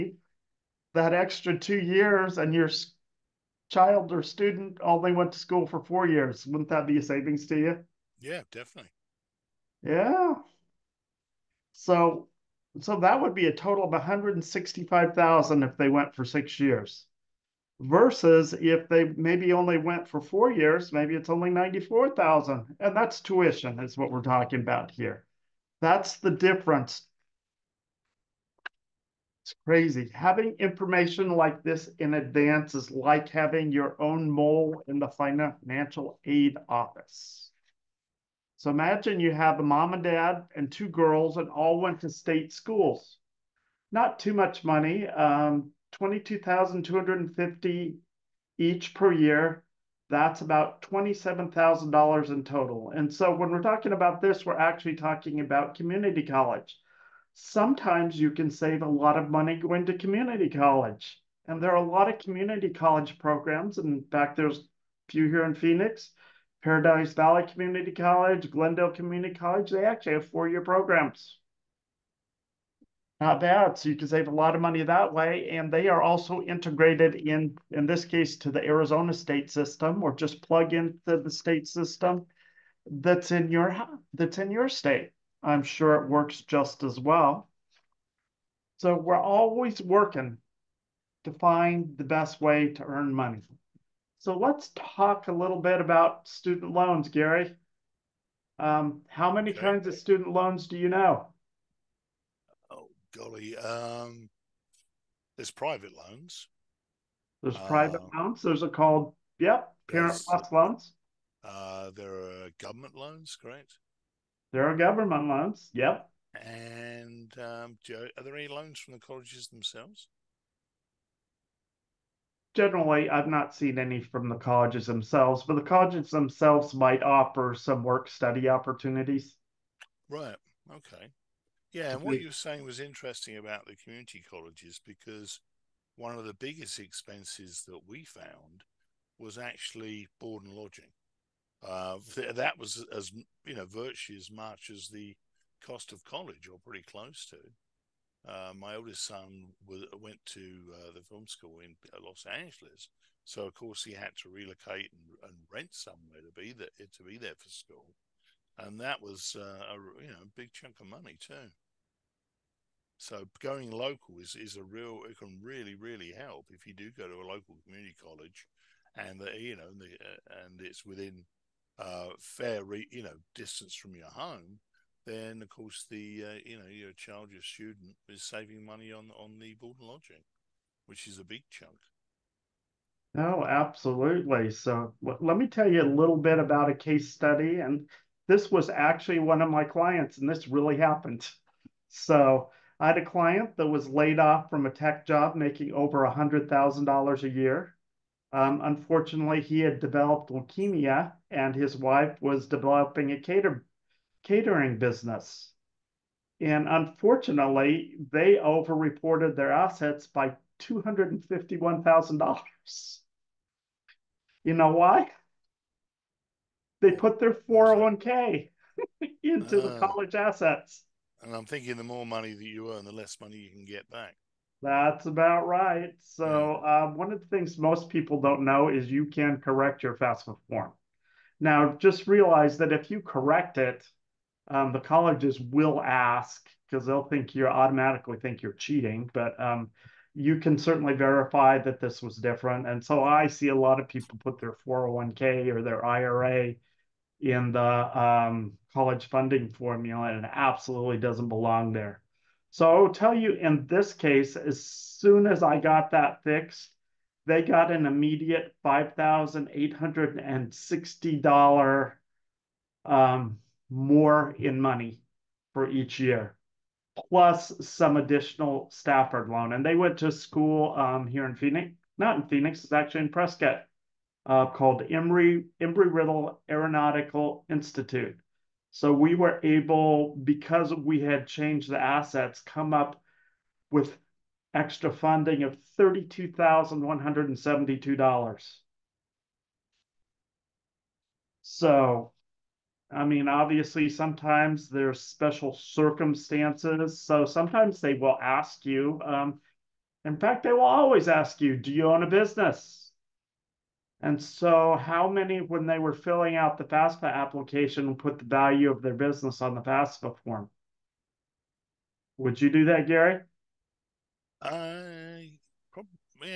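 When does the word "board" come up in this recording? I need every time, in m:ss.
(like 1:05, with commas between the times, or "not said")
2:20, 2:59.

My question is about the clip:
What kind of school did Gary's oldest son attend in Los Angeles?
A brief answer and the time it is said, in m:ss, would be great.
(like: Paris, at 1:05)
film school, at 2:31.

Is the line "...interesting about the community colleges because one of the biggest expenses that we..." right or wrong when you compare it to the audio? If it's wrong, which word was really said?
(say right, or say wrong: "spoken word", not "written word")
right.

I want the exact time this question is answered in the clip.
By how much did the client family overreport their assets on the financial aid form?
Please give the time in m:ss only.
3:30.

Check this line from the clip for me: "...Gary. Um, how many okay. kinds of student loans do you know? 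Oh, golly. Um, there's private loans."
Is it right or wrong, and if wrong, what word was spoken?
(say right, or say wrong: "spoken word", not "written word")
right.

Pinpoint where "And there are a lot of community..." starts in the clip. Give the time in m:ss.
1:01.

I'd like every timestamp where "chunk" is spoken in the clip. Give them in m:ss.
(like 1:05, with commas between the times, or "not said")
2:40, 3:01.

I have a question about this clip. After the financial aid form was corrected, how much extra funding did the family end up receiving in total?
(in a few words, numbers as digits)
$32,172.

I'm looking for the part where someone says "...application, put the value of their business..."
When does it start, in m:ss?
5:07.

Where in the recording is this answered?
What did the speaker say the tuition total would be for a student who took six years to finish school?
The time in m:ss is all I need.
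0:13.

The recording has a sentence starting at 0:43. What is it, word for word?
Not too much money, um, 22,250 each per year.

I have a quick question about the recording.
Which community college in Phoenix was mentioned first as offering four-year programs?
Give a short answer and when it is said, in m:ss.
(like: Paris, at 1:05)
Paradise Valley Community College, at 1:06.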